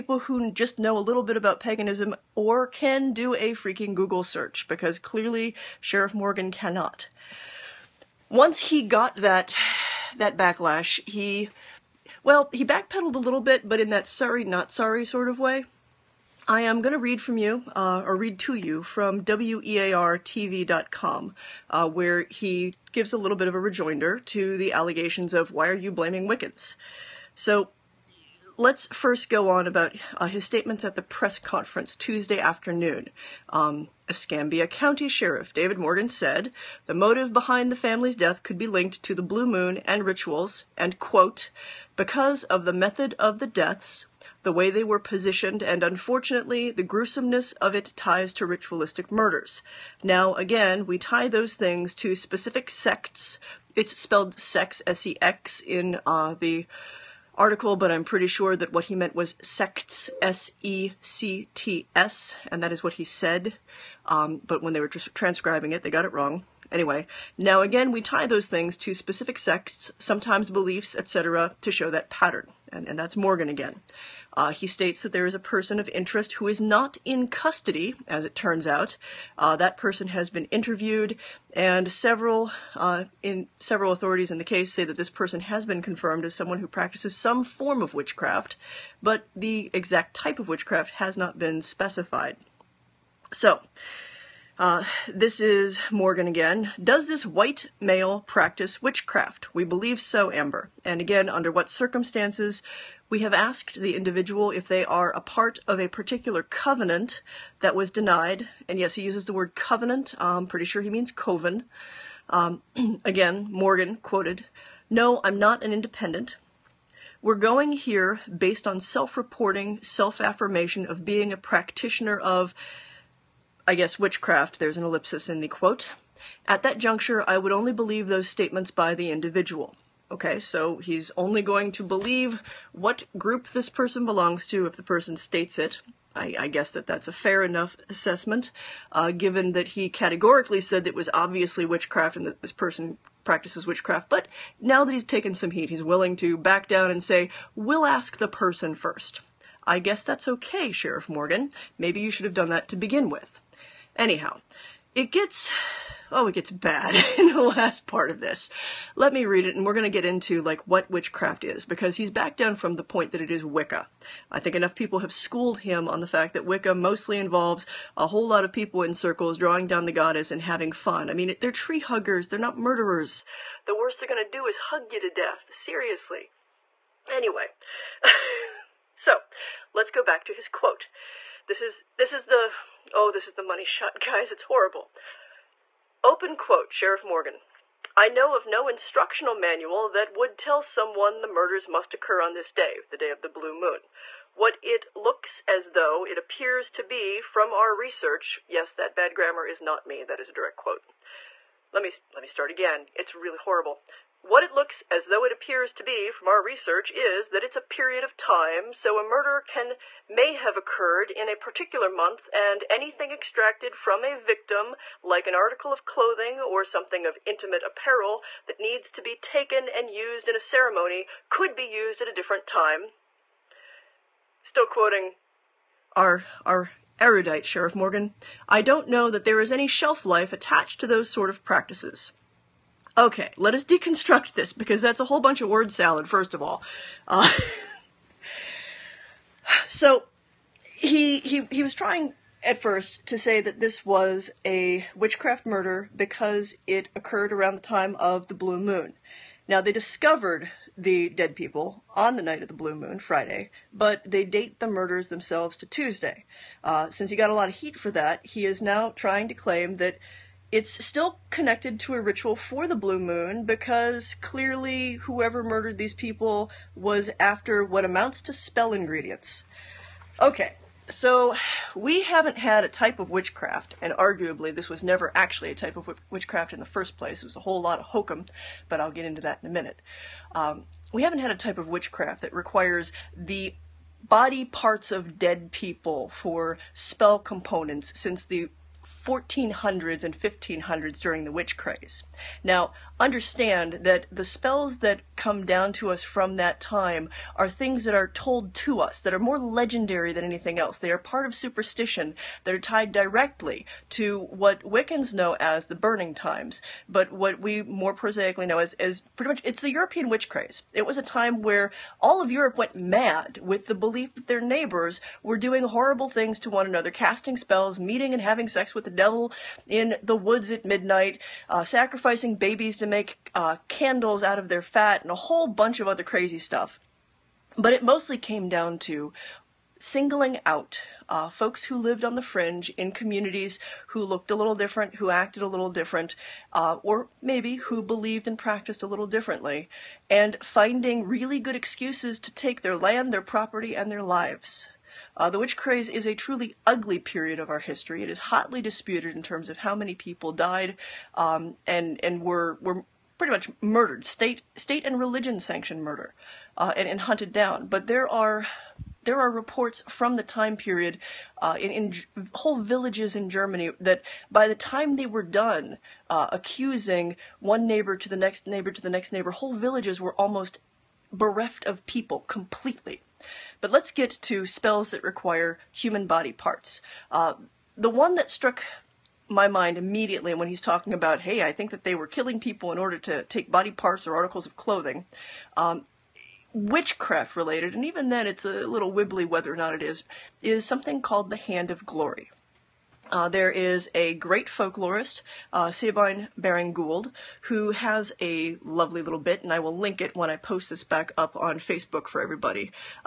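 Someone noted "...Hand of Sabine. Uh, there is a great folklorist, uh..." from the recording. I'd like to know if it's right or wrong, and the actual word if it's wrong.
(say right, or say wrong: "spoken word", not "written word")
wrong: "Glory", not "Sabine".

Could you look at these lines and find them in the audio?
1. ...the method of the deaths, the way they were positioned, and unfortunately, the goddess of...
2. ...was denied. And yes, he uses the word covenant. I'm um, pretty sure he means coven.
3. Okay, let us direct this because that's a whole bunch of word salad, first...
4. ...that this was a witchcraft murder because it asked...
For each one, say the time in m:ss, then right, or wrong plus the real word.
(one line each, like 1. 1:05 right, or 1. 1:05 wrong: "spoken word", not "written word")
1. 0:42 wrong: "gruesomeness", not "goddess"
2. 1:47 right
3. 3:52 wrong: "deconstruct", not "direct"
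4. 4:03 wrong: "occurred", not "asked".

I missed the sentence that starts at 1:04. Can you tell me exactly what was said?
Um, but when they were transcribing it, they got it wrong.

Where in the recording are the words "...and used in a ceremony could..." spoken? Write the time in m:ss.
3:39.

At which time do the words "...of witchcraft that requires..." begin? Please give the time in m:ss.
4:41.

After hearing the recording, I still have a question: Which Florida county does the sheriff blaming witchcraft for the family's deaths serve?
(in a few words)
Escambia County.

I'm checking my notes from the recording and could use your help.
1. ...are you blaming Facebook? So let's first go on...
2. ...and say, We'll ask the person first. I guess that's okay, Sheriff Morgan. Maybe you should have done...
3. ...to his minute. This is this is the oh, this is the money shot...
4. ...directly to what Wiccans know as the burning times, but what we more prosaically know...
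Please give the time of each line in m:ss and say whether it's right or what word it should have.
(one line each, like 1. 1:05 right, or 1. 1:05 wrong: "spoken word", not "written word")
1. 0:25 wrong: "Wiccans", not "Facebook"
2. 2:26 right
3. 3:00 wrong: "quote", not "minute"
4. 5:02 right.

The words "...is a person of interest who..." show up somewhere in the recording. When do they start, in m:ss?
1:15.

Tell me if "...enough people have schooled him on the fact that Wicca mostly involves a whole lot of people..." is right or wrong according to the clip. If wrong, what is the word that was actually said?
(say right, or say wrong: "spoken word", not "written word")
right.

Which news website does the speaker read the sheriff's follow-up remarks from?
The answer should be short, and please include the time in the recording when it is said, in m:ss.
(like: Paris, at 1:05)
WEARTV.com, at 0:19.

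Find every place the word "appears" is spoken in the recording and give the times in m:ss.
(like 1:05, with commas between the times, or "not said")
3:16, 3:25.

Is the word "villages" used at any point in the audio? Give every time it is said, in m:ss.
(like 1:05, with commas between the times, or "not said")
6:02, 6:09.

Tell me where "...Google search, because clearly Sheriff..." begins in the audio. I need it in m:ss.
0:03.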